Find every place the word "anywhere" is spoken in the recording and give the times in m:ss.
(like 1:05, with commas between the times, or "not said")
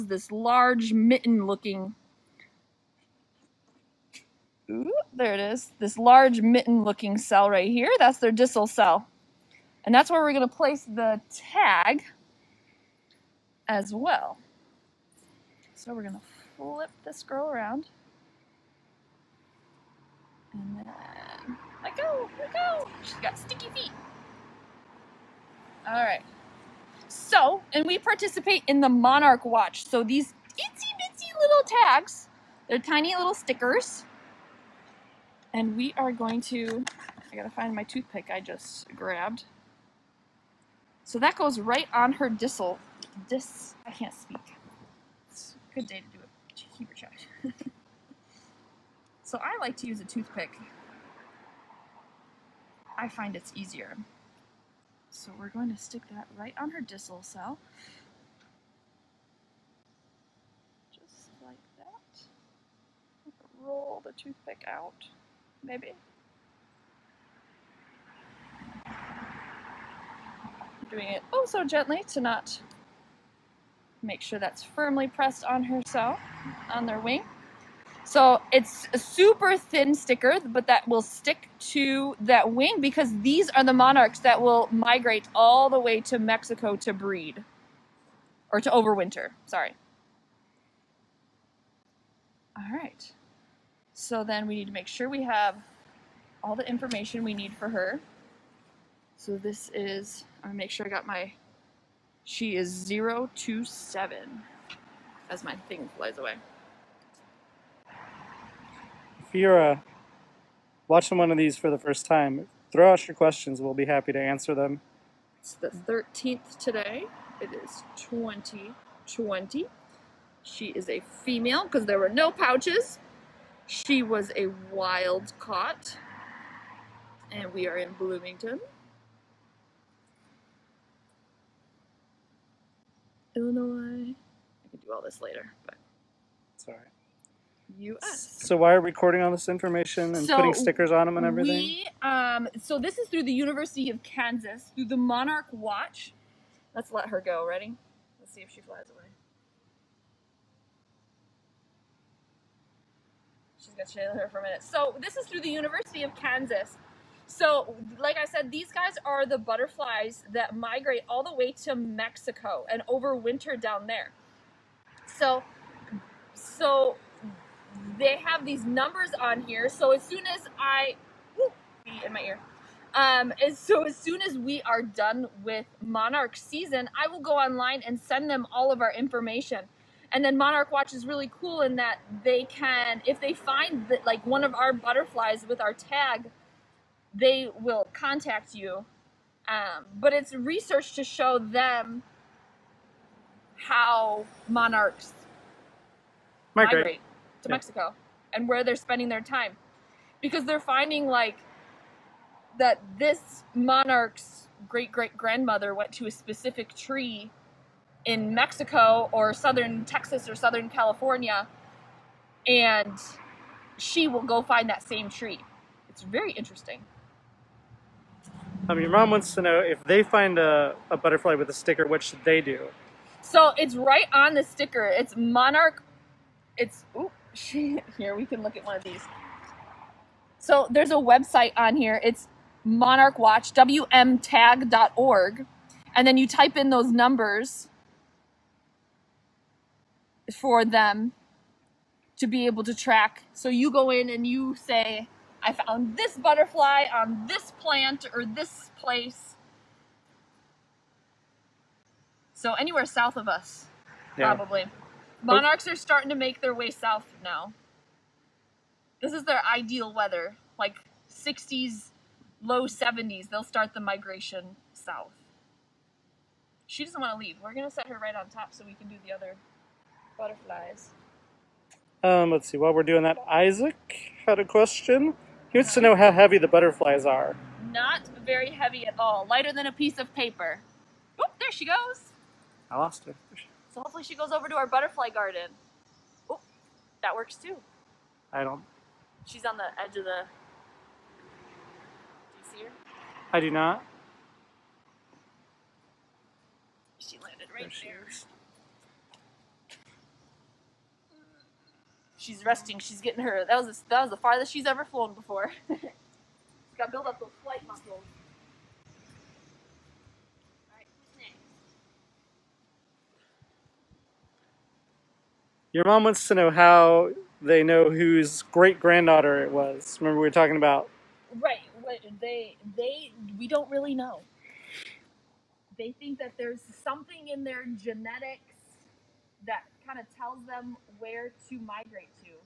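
4:12.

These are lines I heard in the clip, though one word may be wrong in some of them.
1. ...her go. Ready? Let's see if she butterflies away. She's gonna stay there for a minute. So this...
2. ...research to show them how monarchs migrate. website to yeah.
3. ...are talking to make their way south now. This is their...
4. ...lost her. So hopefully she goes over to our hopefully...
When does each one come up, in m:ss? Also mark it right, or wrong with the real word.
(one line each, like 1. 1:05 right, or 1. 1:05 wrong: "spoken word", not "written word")
1. 2:27 wrong: "flies", not "butterflies"
2. 3:10 wrong: "migrate", not "website"
3. 4:15 wrong: "starting", not "talking"
4. 4:42 wrong: "butterfly", not "hopefully".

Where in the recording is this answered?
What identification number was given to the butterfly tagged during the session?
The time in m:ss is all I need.
1:42.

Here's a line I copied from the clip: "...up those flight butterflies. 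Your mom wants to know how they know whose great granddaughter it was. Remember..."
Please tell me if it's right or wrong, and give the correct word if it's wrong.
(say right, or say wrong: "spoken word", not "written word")
wrong: "muscles", not "butterflies".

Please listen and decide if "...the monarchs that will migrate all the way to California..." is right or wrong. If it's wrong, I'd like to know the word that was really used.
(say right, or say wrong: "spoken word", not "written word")
wrong: "Mexico", not "California".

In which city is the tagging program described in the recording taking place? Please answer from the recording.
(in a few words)
Bloomington.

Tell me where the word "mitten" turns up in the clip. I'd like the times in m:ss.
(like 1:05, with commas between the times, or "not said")
0:00, 0:06.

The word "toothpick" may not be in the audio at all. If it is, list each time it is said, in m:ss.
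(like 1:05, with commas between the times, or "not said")
0:37, 0:50, 1:04.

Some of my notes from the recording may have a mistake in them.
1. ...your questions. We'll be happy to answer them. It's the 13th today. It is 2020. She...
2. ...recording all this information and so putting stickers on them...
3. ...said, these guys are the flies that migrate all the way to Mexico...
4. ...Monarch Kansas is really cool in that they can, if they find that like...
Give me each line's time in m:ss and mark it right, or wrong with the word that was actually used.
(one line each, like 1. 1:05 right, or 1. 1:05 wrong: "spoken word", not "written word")
1. 1:53 right
2. 2:18 right
3. 2:38 wrong: "butterflies", not "flies"
4. 3:00 wrong: "Watch", not "Kansas".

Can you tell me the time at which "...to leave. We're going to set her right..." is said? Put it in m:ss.
4:27.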